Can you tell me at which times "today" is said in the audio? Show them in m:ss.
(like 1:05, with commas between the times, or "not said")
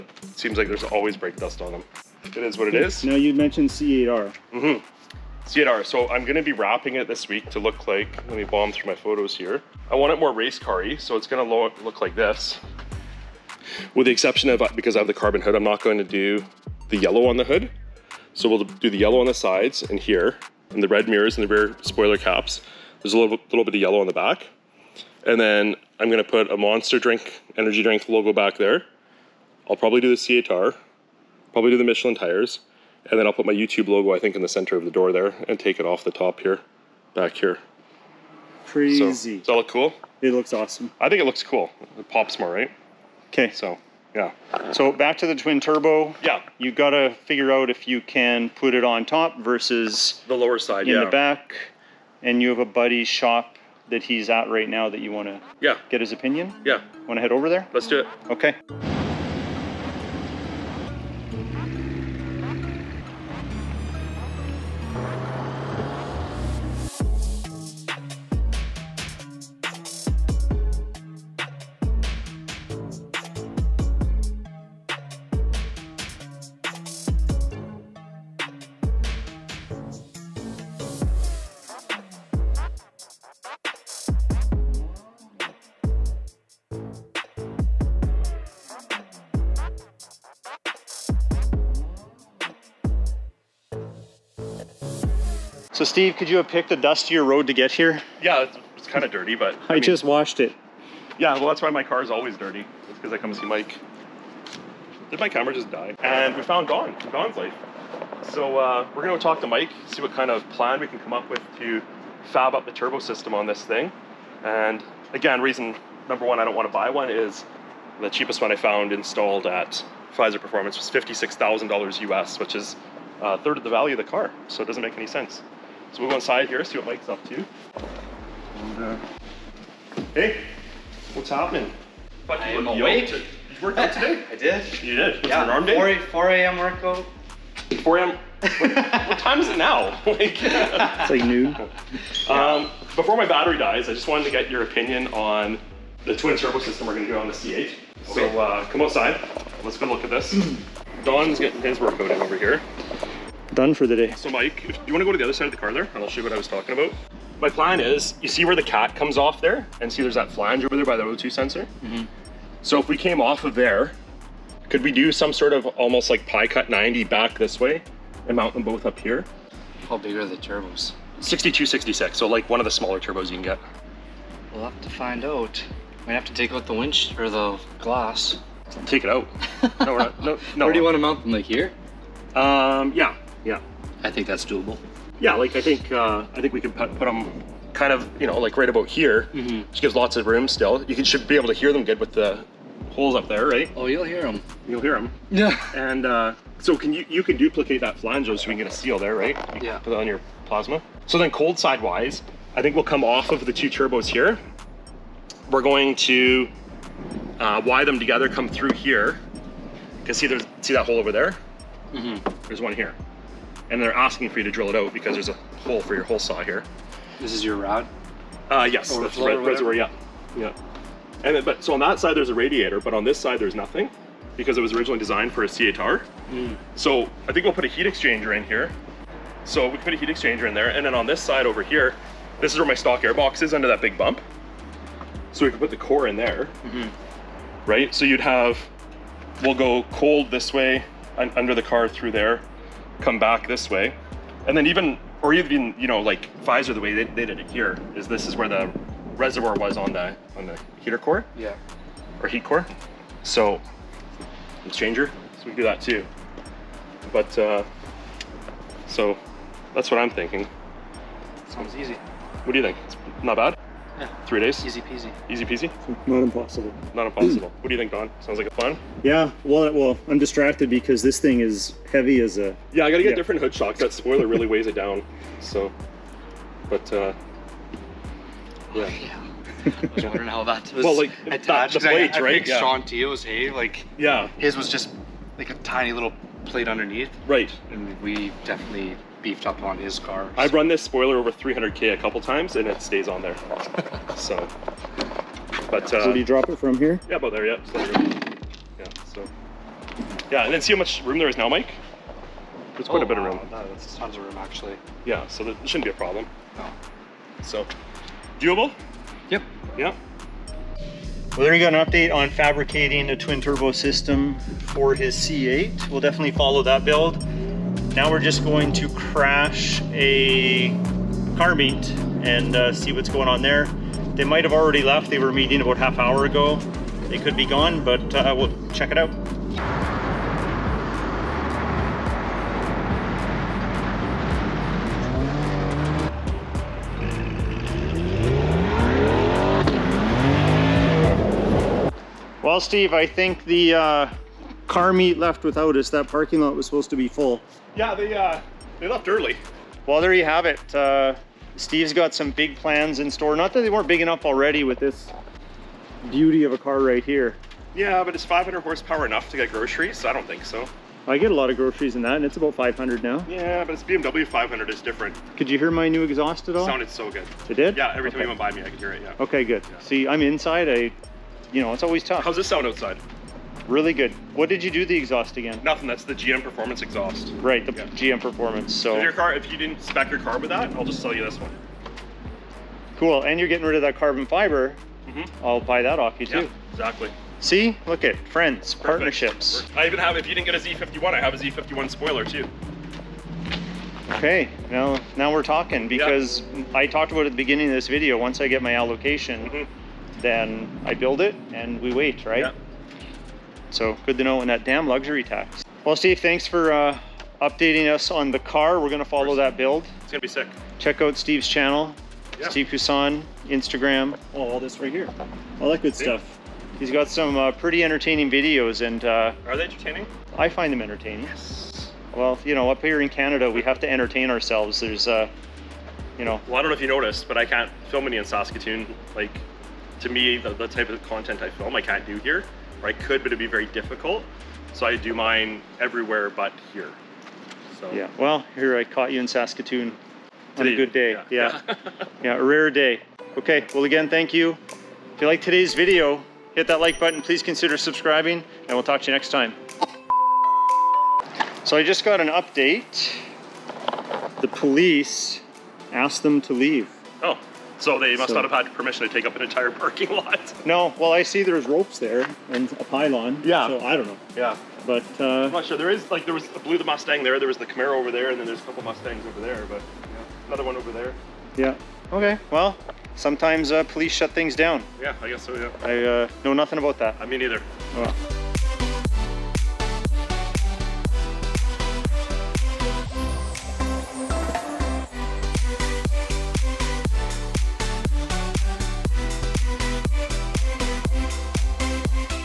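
2:13, 7:25.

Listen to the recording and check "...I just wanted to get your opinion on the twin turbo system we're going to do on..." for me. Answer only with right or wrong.
right.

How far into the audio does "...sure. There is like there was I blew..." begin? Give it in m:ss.
7:45.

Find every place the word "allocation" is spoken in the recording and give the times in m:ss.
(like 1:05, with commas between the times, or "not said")
6:38.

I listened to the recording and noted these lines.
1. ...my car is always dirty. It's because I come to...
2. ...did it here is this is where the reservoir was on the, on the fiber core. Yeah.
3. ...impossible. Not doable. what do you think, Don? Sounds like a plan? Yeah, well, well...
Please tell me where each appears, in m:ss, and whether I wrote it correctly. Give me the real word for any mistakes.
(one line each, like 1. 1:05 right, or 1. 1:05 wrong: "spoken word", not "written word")
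1. 1:41 right
2. 4:07 wrong: "heater", not "fiber"
3. 4:26 wrong: "impossible", not "doable".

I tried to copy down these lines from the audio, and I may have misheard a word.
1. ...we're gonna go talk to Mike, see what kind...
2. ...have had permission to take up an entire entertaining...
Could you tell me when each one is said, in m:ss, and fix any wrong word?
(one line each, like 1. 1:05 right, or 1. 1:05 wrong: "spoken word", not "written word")
1. 1:48 right
2. 7:38 wrong: "parking", not "entertaining".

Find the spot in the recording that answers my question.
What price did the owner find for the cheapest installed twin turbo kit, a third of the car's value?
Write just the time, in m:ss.
2:00.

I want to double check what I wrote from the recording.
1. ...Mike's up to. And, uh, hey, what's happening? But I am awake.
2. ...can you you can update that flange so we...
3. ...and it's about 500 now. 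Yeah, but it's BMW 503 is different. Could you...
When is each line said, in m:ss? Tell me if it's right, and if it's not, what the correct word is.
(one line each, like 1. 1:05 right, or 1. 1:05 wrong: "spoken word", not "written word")
1. 2:06 right
2. 3:16 wrong: "duplicate", not "update"
3. 6:02 wrong: "500", not "503".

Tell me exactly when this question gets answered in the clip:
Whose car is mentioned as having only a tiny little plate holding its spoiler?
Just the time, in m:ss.
4:42.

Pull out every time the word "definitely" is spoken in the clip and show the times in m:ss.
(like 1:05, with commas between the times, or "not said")
4:48, 5:15.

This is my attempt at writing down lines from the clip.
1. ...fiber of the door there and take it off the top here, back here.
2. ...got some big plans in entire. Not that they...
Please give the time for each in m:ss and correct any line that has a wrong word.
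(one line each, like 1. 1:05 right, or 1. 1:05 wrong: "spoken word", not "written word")
1. 0:34 wrong: "center", not "fiber"
2. 5:51 wrong: "store", not "entire".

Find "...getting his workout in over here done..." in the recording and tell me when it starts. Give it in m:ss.
2:31.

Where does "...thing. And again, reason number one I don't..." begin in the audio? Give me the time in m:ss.
1:53.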